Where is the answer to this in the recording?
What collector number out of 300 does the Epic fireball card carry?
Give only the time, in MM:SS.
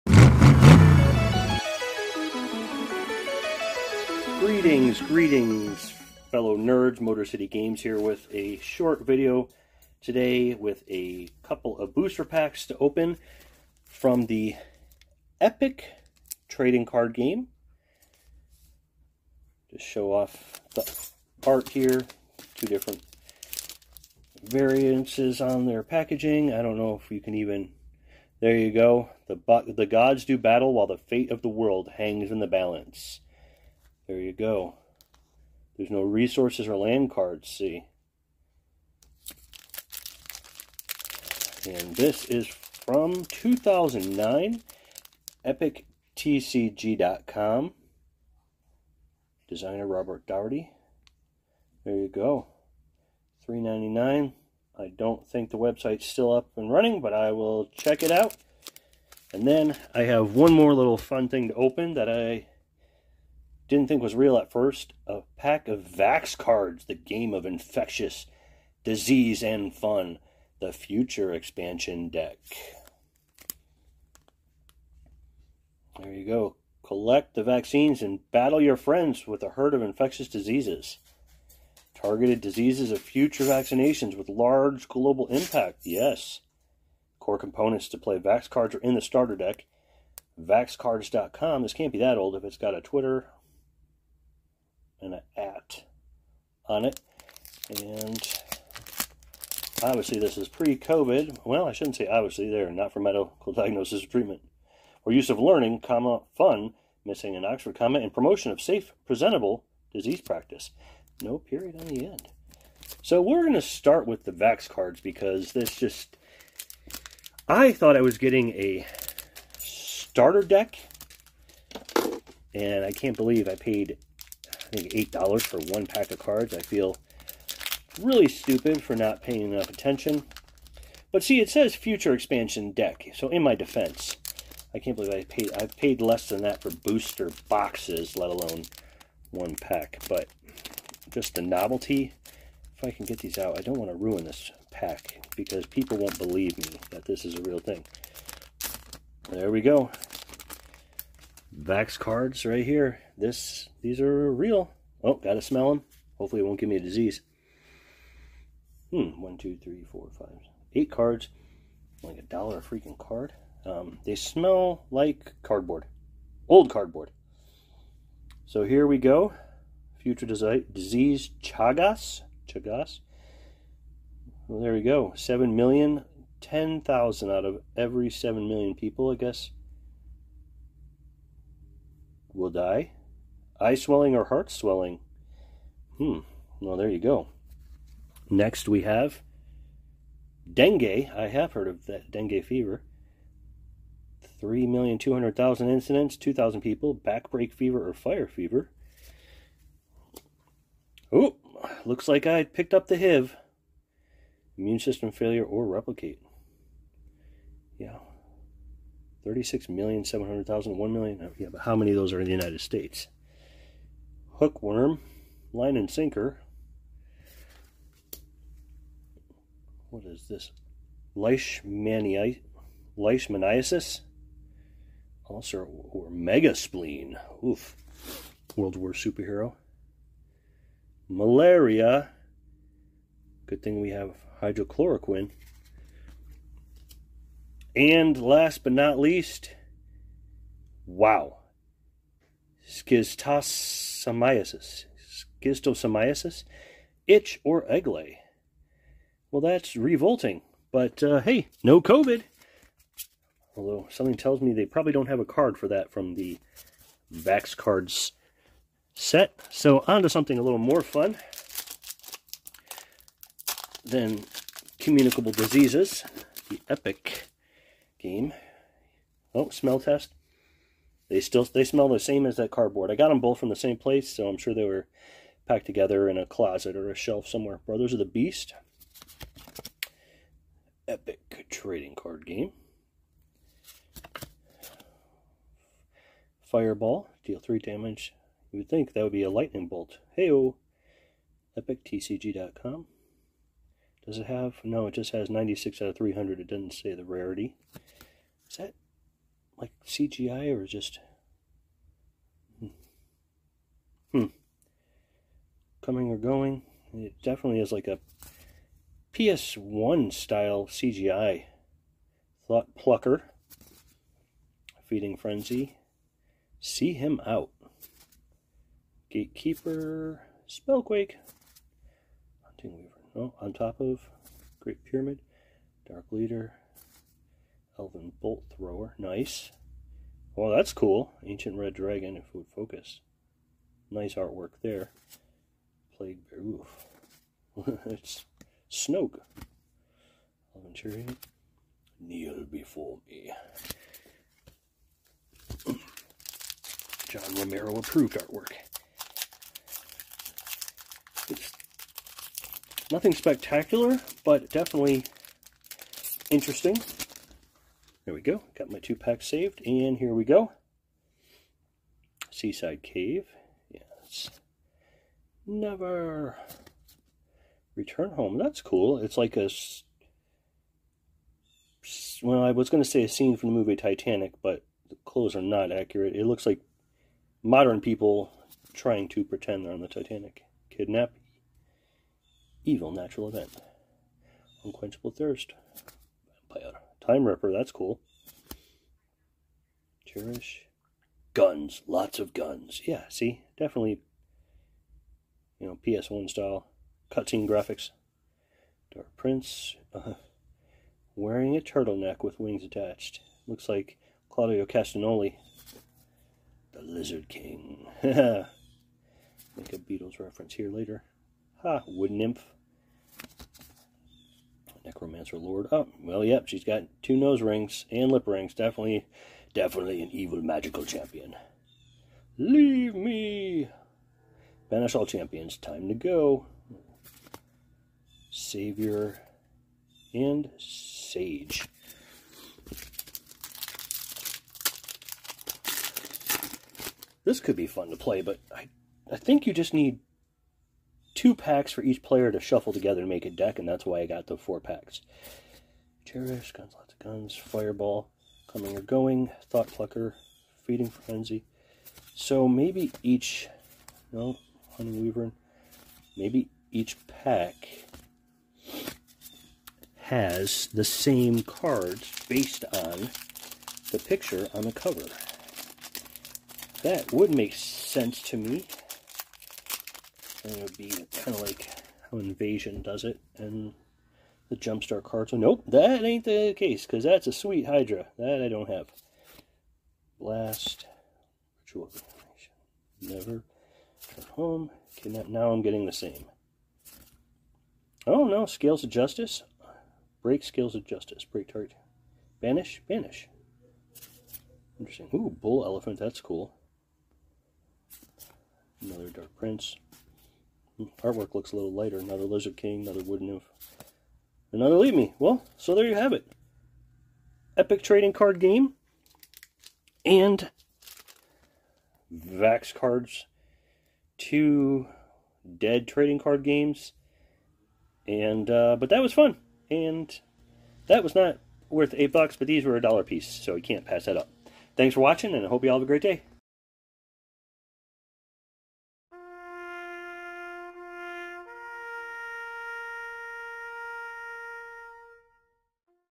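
04:55.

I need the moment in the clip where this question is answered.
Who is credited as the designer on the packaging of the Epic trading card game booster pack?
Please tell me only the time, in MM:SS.
00:49.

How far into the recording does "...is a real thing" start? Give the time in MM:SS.
02:27.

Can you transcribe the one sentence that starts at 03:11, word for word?
I have heard of that dengue fever.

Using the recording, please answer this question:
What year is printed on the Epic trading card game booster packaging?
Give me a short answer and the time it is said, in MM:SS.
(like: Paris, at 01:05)
2009, at 00:43.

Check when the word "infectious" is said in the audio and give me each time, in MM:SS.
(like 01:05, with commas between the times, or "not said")
01:07, 01:19.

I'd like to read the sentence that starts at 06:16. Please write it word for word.
It looks like modern people trying to pretend they're on the Titanic.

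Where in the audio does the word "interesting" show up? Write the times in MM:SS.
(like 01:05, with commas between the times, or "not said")
05:56, 08:14.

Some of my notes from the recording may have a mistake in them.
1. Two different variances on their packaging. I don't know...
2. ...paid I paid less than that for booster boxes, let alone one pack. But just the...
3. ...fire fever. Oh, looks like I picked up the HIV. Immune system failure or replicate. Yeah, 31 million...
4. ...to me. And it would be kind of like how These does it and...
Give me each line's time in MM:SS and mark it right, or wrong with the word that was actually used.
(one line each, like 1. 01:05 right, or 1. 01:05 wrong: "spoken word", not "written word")
1. 00:22 right
2. 02:15 right
3. 03:17 wrong: "36", not "31"
4. 07:48 wrong: "Invasion", not "These".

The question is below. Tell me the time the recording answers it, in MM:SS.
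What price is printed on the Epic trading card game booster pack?
00:53.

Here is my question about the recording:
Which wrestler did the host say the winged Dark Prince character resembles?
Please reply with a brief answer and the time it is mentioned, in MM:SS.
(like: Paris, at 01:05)
Claudio Castagnoli, at 06:44.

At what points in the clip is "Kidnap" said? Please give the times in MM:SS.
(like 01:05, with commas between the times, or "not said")
06:20, 08:04.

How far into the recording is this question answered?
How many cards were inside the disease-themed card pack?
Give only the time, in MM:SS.
02:40.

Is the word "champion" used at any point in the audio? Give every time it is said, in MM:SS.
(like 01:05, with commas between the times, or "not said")
07:00, 07:05.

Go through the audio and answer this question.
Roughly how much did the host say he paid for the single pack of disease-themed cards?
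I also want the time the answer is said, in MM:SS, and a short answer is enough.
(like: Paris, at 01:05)
$8, at 02:05.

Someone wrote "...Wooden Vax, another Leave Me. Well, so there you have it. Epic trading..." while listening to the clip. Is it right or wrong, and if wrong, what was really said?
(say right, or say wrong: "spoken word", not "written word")
wrong: "Nymph", not "Vax".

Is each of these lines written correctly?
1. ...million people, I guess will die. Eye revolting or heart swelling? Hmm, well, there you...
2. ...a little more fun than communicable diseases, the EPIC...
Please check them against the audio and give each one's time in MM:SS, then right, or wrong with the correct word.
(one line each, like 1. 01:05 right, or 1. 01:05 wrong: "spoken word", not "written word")
1. 02:58 wrong: "swelling", not "revolting"
2. 04:20 right.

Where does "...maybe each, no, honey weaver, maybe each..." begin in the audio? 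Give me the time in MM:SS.
07:32.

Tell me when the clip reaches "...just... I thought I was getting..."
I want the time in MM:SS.
01:55.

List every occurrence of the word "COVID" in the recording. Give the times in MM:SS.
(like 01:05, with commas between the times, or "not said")
01:40, 04:11.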